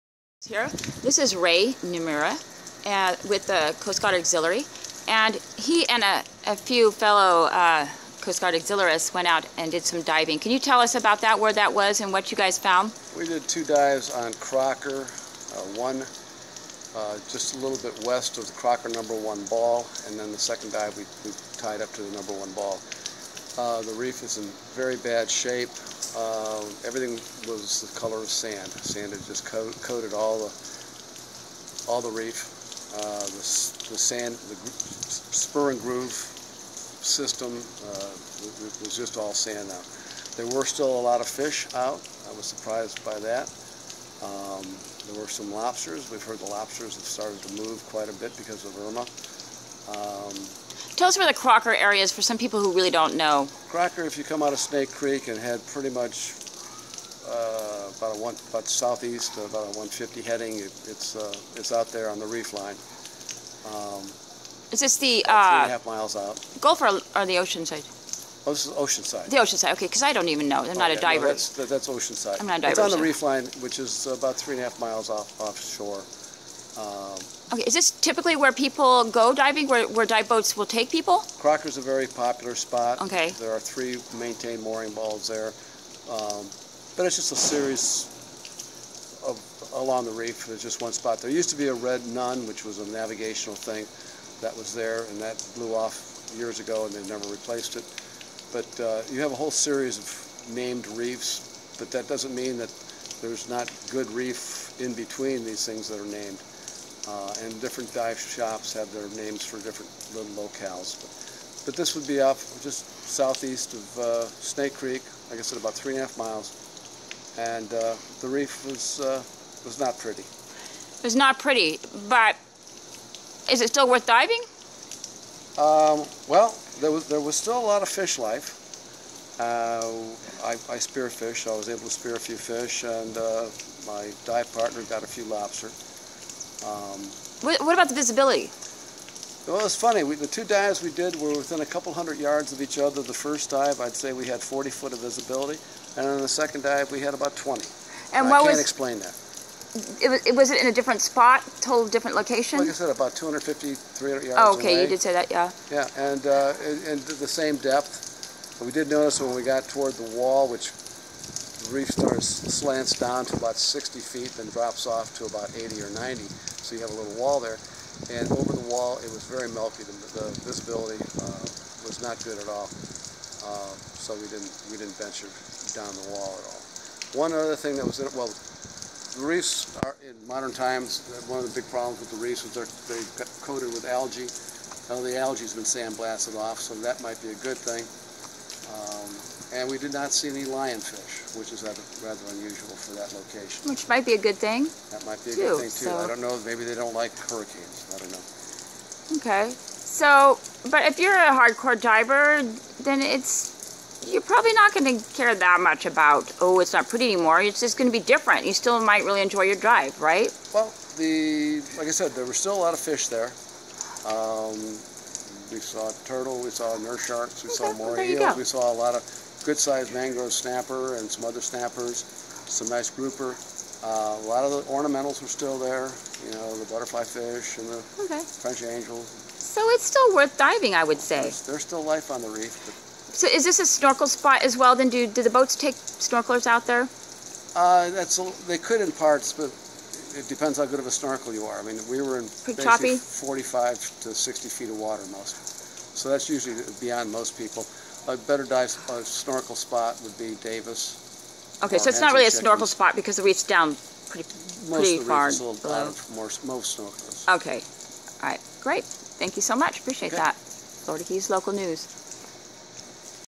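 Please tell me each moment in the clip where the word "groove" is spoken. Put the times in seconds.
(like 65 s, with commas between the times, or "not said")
35 s.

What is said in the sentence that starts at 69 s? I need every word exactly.
The side, okay, because I don't even know.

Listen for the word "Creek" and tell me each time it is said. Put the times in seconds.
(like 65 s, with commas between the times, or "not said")
54 s, 114 s.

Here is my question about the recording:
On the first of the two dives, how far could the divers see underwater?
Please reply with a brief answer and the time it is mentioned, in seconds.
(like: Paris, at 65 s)
40 feet, at 144 s.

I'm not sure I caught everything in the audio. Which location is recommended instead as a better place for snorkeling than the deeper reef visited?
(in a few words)
Davis.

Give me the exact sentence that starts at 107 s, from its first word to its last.
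Uh, and different dive shops have their names for different little locales.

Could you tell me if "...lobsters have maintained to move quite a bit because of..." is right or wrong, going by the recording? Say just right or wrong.
wrong.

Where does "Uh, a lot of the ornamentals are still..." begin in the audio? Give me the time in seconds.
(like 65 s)
223 s.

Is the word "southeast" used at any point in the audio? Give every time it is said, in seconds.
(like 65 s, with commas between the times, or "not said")
58 s, 113 s.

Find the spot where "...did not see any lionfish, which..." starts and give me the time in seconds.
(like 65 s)
189 s.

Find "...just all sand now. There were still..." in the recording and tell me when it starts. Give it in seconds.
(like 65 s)
38 s.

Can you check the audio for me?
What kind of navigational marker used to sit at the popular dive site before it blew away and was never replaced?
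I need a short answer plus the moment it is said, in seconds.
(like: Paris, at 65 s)
red nun, at 91 s.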